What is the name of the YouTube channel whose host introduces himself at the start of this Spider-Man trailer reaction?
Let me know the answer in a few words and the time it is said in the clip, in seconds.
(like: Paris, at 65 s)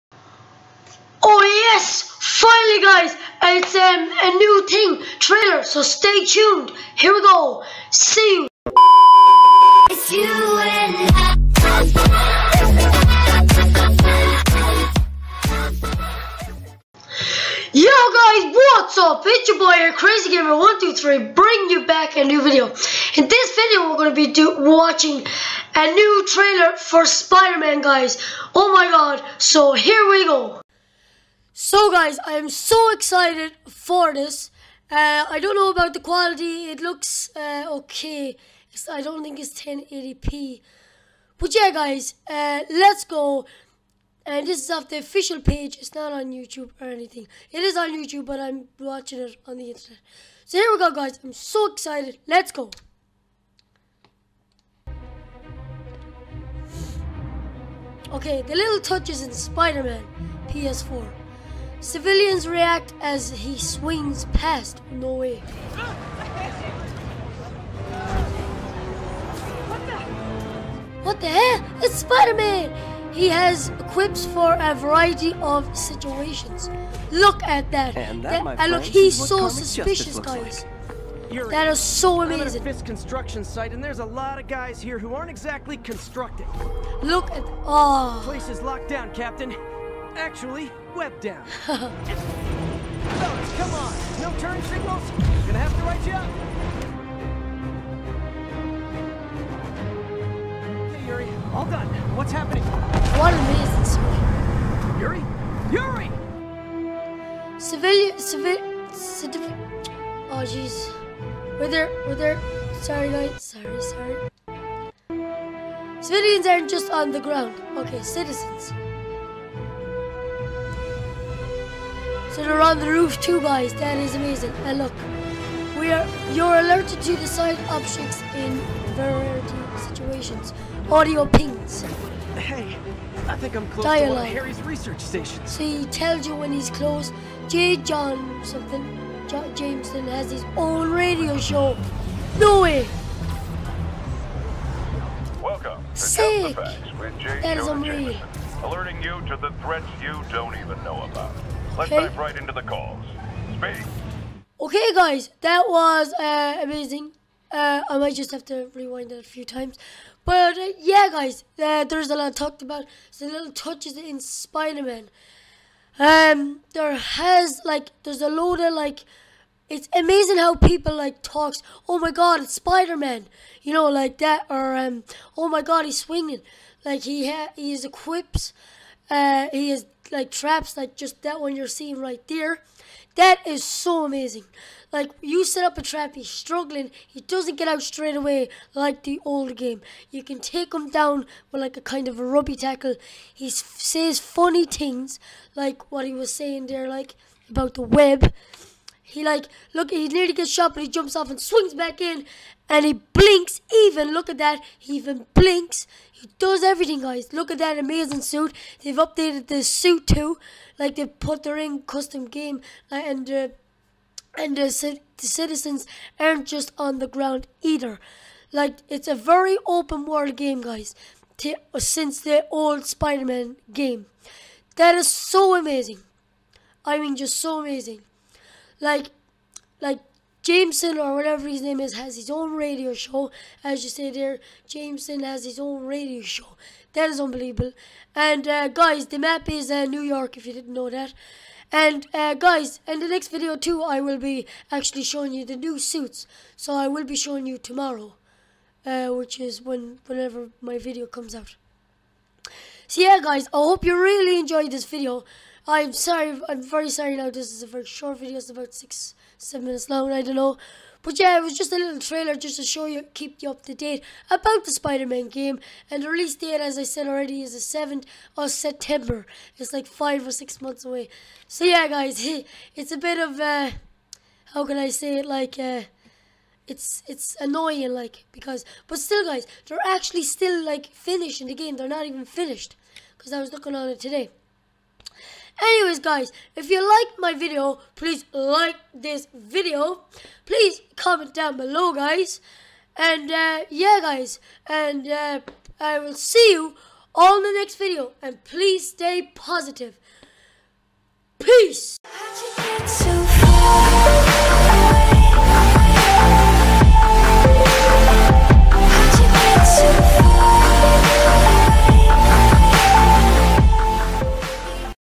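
Crazy Gamer 123, at 19 s.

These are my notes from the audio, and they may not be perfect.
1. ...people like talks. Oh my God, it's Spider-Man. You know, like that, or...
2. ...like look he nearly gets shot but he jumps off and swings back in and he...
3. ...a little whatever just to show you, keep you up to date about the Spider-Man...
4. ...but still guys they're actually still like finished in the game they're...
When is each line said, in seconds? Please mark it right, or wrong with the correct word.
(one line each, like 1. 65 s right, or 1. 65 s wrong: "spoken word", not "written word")
1. 170 s right
2. 199 s right
3. 261 s wrong: "trailer", not "whatever"
4. 278 s right.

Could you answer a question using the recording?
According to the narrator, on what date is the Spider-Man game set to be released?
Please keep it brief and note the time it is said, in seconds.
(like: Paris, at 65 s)
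7th of September, at 267 s.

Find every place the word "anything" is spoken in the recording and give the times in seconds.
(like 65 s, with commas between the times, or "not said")
46 s.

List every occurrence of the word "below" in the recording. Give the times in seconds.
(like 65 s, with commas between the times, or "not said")
291 s.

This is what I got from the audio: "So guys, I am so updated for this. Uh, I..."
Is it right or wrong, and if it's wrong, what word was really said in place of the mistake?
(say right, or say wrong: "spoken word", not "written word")
wrong: "excited", not "updated".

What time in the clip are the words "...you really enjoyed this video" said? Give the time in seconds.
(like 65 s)
253 s.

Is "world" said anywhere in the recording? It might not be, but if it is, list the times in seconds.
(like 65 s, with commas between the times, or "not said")
220 s.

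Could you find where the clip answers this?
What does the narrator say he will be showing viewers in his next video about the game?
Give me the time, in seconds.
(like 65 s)
245 s.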